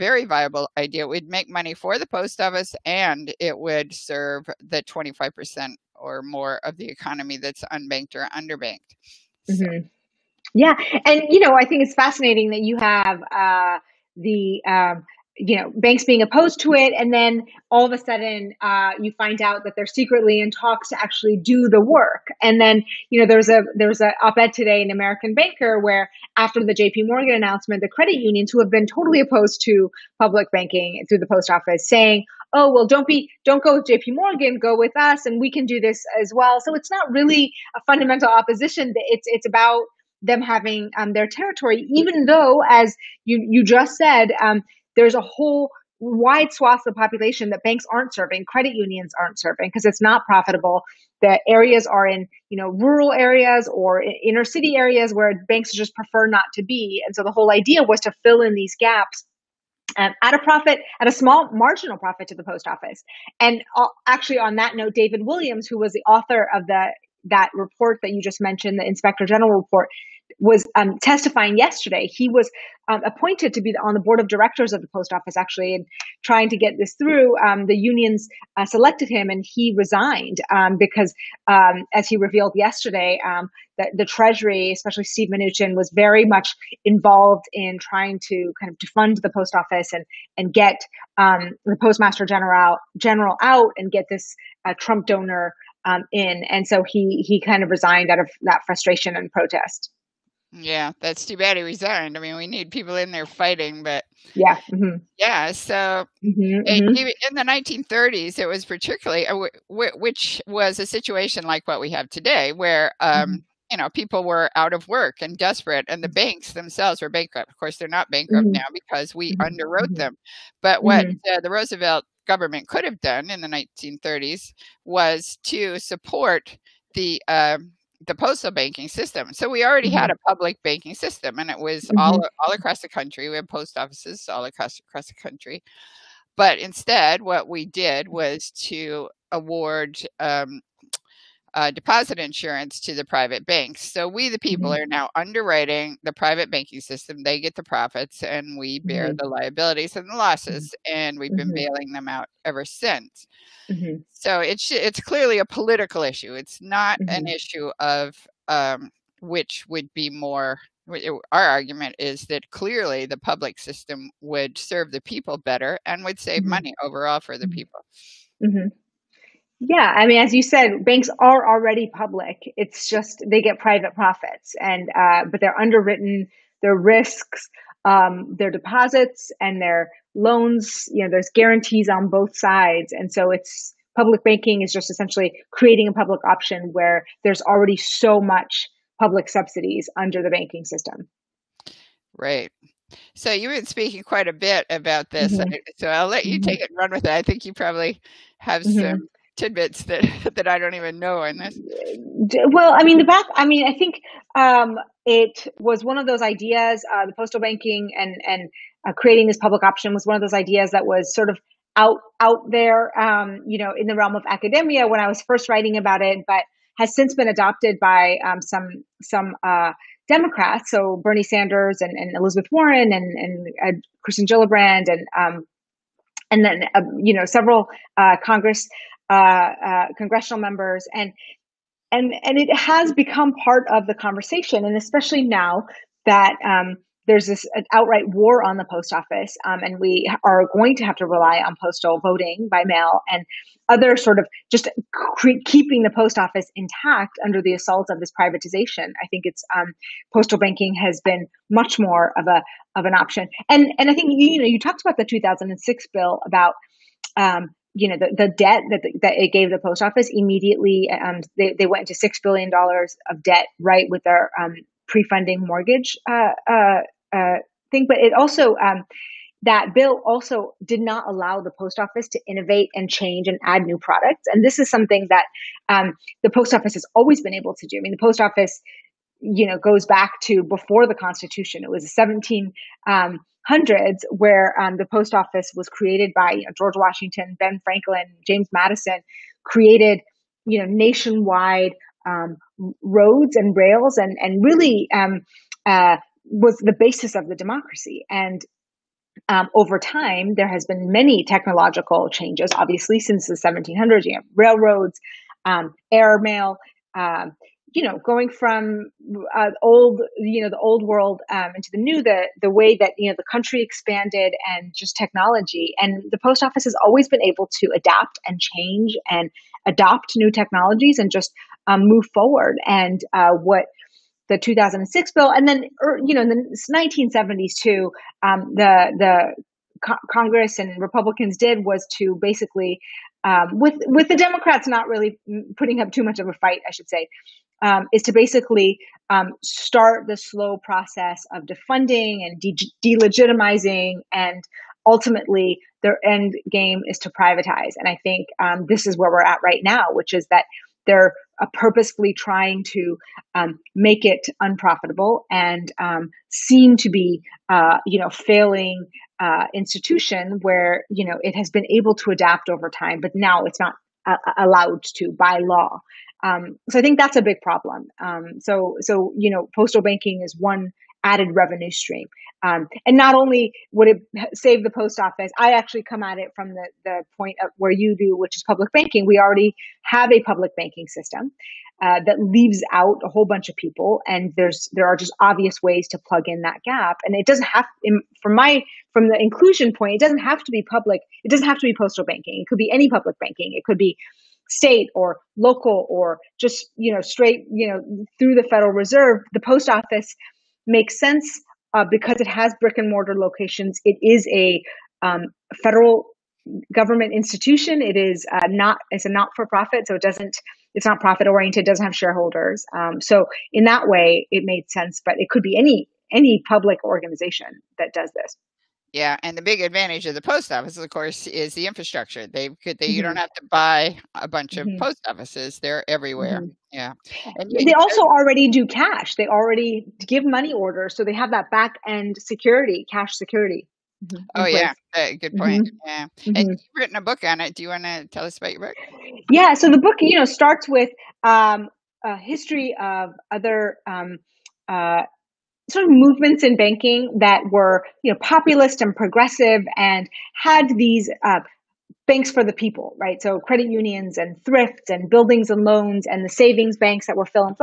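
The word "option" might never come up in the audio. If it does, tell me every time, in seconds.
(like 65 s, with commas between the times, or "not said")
186 s, 209 s, 252 s.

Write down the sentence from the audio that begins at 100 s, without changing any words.
Yeah, that's too bad he resigned.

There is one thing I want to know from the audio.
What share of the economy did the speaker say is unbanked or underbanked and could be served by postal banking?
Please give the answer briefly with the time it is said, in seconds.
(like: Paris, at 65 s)
25% or more, at 4 s.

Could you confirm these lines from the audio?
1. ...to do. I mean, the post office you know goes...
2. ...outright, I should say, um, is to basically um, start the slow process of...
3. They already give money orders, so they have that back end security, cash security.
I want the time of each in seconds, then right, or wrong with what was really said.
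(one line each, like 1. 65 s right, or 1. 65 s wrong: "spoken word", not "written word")
1. 277 s right
2. 336 s wrong: "fight", not "outright"
3. 429 s right.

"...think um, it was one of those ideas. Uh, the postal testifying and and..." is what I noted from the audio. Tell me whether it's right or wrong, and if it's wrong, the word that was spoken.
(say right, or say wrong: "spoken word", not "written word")
wrong: "banking", not "testifying".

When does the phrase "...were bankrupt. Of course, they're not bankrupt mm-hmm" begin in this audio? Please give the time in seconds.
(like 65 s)
117 s.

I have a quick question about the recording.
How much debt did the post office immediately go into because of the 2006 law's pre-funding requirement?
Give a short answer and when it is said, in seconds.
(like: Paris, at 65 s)
$6 billion, at 261 s.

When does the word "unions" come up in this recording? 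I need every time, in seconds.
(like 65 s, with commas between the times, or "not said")
28 s, 48 s, 77 s, 453 s.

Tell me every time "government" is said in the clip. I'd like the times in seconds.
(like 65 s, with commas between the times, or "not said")
122 s, 406 s.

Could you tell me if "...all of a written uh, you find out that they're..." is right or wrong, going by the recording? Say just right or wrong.
wrong.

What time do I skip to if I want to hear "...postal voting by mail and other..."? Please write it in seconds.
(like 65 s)
241 s.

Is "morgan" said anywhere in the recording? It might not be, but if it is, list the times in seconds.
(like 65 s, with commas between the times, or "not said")
27 s, 34 s.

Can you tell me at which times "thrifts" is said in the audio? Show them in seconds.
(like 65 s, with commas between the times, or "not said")
454 s.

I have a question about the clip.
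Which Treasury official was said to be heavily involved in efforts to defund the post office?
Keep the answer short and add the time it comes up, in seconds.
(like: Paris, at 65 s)
Steve Mnuchin, at 85 s.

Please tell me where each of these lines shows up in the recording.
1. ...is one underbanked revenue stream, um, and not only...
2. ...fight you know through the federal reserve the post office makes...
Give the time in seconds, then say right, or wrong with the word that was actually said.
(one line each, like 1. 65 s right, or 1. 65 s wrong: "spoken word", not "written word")
1. 370 s wrong: "added", not "underbanked"
2. 397 s wrong: "straight", not "fight".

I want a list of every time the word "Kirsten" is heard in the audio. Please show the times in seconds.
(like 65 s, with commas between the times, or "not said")
224 s.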